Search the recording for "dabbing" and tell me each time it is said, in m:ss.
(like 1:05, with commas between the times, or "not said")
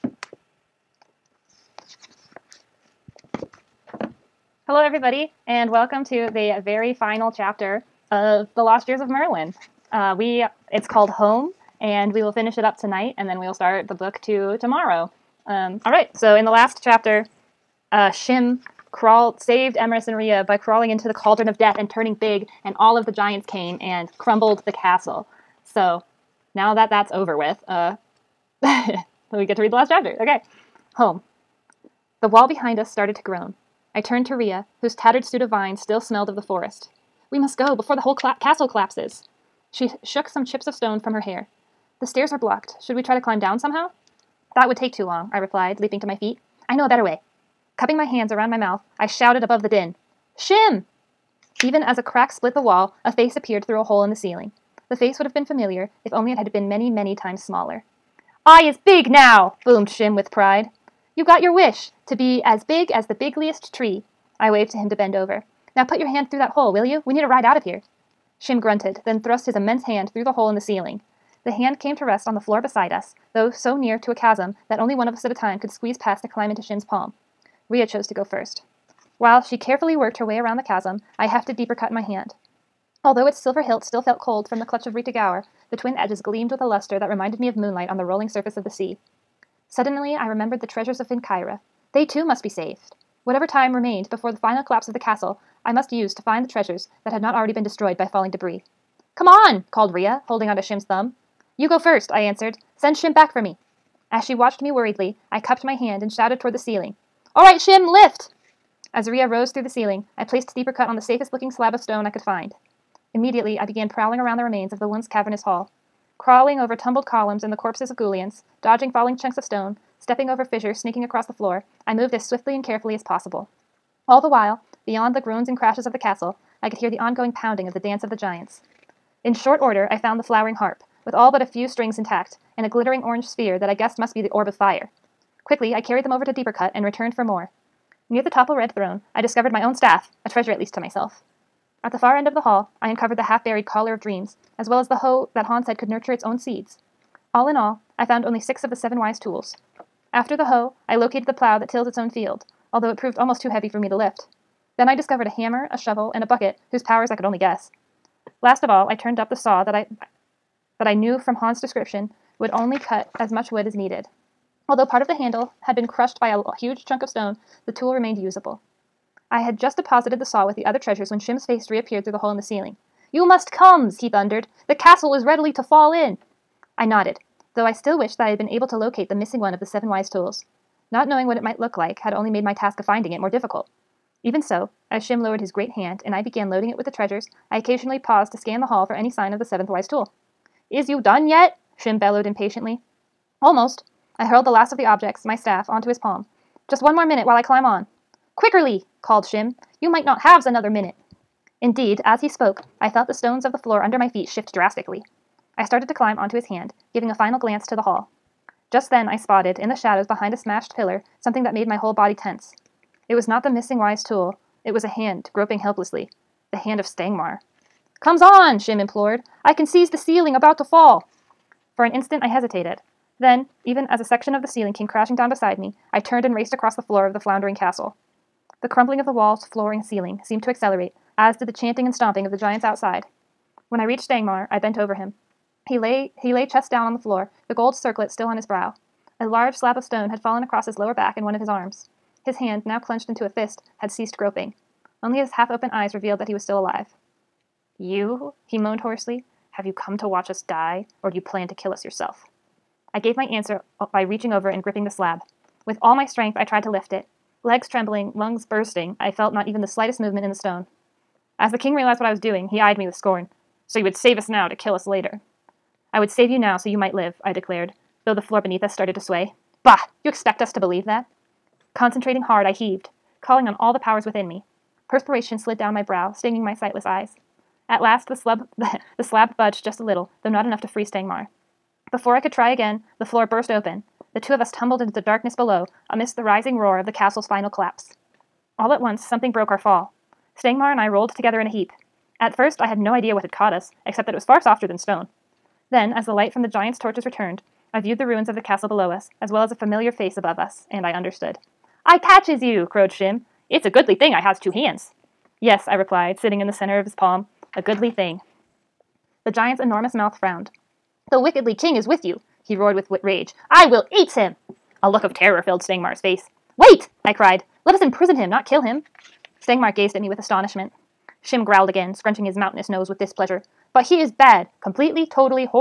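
not said.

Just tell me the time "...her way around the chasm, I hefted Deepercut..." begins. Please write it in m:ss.
1:20.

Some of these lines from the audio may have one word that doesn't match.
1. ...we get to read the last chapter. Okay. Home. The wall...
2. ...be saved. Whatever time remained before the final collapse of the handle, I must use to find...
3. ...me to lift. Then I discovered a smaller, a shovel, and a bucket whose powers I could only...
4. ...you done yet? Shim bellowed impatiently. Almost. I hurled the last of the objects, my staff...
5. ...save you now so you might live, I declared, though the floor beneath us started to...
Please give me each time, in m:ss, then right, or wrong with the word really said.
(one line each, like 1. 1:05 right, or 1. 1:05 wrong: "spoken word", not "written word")
1. 0:28 right
2. 1:32 wrong: "castle", not "handle"
3. 2:33 wrong: "hammer", not "smaller"
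4. 3:10 right
5. 4:26 right.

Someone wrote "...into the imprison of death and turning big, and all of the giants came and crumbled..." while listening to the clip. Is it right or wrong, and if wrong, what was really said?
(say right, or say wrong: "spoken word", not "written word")
wrong: "cauldron", not "imprison".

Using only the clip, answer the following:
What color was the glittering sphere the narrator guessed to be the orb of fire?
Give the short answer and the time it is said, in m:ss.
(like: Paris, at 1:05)
Orange, at 2:13.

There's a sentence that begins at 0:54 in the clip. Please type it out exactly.
The face would have been familiar if only it had been many, many times smaller.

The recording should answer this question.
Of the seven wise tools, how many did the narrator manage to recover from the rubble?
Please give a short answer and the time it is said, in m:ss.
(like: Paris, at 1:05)
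6, at 2:28.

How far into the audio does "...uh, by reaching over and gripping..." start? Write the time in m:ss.
4:13.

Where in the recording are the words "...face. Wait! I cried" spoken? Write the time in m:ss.
5:15.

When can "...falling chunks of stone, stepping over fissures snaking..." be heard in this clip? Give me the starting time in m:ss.
1:58.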